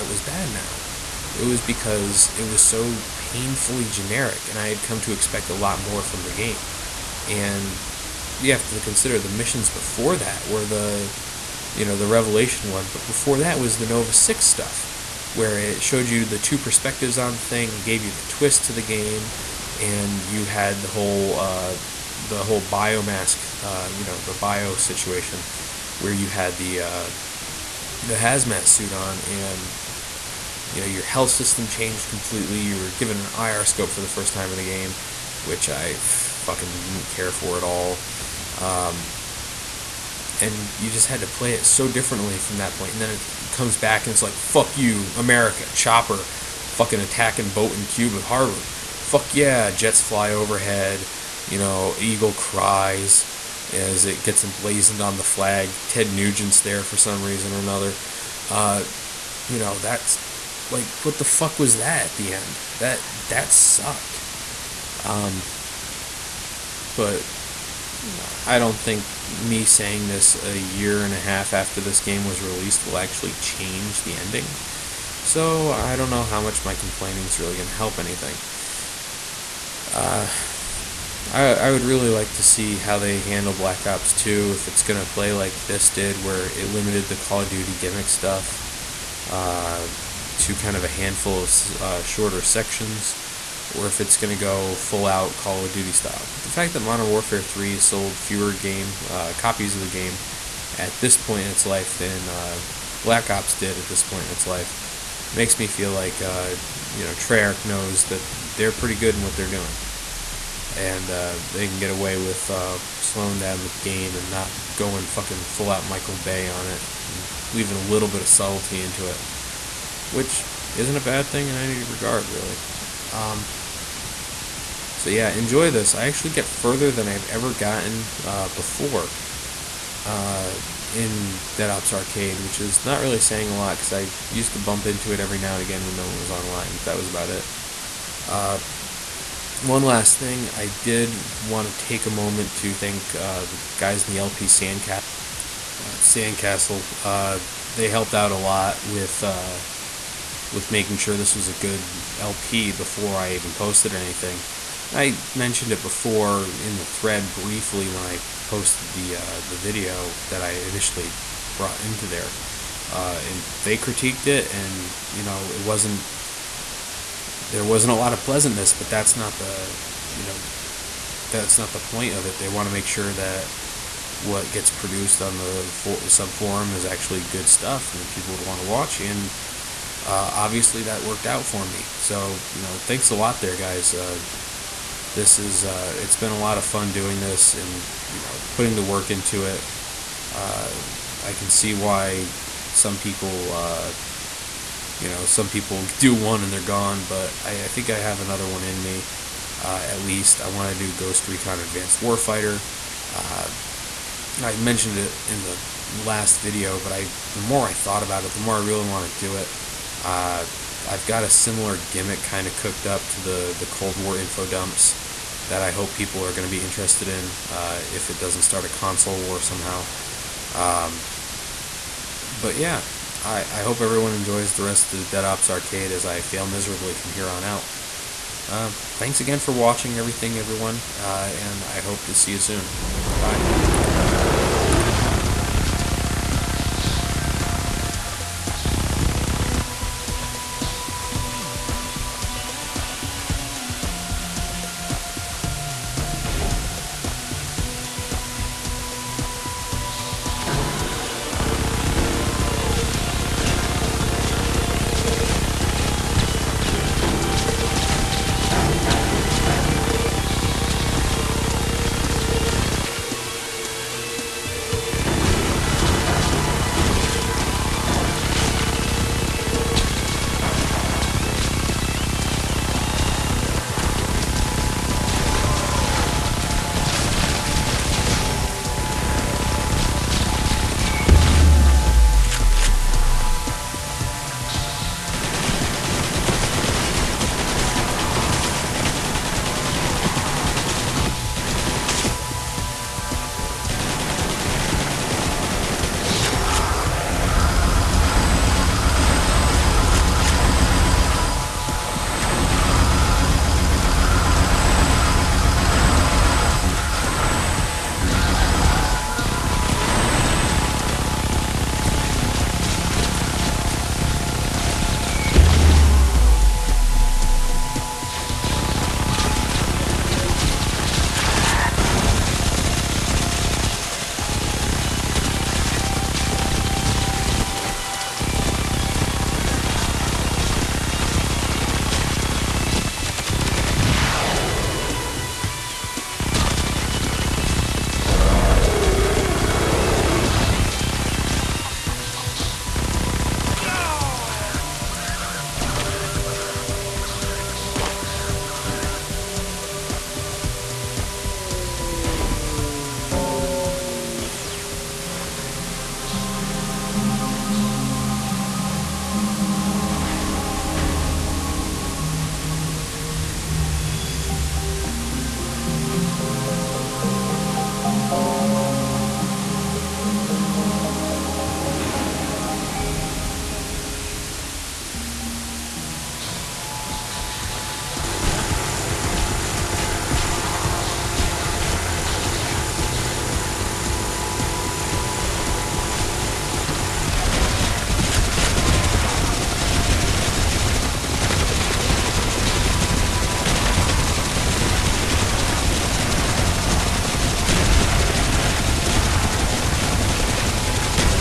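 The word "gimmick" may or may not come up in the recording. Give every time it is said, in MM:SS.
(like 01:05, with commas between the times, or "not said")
01:27, 03:31.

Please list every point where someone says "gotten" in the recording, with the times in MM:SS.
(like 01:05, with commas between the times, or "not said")
02:07.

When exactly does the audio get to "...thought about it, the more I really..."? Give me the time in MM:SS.
03:27.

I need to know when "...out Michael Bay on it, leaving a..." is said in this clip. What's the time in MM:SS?
01:55.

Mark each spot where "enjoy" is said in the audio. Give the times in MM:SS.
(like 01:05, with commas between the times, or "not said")
02:05, 03:44.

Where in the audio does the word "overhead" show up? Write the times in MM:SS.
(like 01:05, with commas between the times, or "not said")
00:50.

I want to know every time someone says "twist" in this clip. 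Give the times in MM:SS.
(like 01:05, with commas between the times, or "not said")
00:18.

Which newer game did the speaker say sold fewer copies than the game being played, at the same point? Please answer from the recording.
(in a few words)
Modern Warfare 3.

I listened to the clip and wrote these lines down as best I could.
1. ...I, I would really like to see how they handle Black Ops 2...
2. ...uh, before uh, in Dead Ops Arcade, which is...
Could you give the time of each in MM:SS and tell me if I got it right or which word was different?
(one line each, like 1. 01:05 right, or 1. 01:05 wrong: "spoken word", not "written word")
1. 01:21 right
2. 02:08 right.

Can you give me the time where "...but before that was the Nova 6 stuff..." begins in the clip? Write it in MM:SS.
00:12.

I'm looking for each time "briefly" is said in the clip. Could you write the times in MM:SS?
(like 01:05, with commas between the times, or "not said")
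02:37.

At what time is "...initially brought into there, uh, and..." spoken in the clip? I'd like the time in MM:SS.
02:40.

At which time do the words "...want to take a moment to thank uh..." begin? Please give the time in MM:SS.
02:21.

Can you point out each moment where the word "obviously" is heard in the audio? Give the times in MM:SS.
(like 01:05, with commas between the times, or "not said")
03:00.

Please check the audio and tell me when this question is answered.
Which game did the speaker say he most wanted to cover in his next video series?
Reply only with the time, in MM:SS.
03:20.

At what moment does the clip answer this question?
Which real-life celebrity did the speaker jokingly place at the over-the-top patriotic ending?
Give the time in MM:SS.
00:55.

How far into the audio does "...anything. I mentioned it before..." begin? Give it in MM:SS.
02:33.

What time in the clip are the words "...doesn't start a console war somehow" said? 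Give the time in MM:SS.
03:38.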